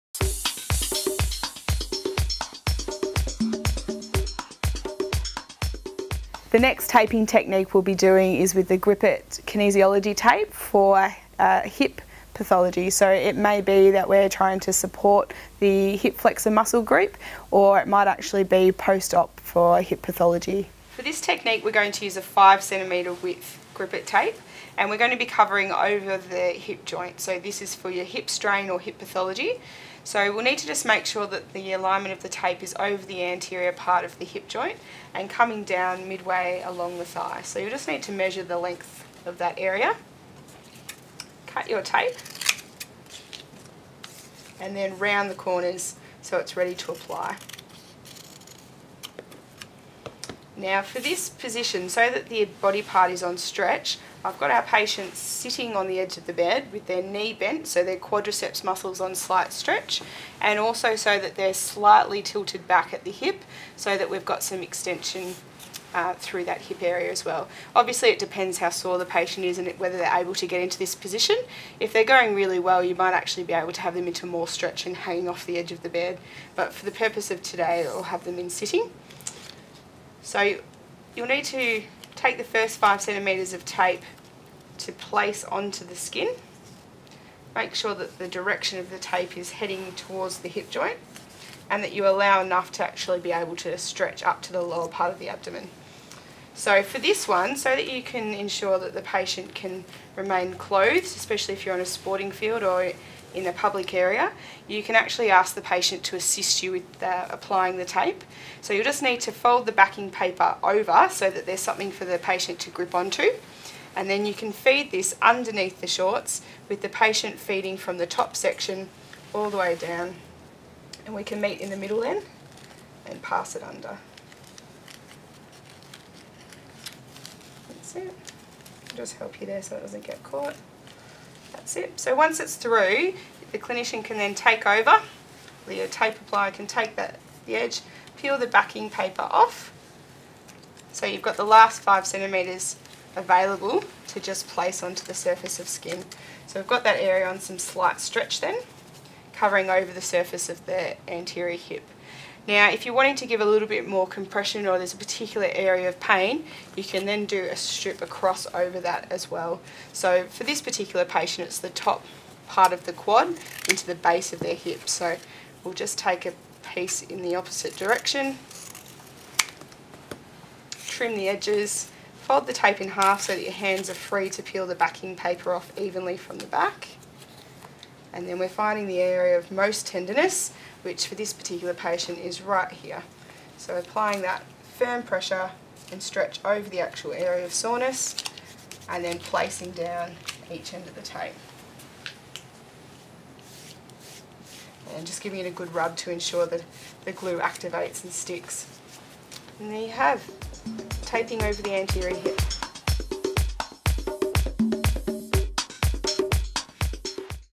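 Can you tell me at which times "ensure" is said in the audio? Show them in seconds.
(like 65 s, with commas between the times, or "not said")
98 s, 196 s.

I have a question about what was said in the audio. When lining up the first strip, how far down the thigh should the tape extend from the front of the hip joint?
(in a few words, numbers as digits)
midway.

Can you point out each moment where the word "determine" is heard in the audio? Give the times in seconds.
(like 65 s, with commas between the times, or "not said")
not said.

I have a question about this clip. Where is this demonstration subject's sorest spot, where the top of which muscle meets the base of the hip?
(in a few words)
quad.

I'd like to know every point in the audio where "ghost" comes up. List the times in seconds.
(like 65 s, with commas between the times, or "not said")
not said.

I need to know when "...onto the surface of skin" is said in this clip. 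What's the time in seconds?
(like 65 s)
144 s.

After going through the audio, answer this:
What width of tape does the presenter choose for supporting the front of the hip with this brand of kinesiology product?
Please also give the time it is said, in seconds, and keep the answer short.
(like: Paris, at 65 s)
5 centimetre, at 22 s.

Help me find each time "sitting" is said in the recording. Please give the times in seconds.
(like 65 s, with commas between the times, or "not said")
55 s, 78 s.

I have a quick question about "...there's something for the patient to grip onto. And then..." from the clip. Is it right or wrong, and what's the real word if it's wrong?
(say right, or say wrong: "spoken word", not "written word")
right.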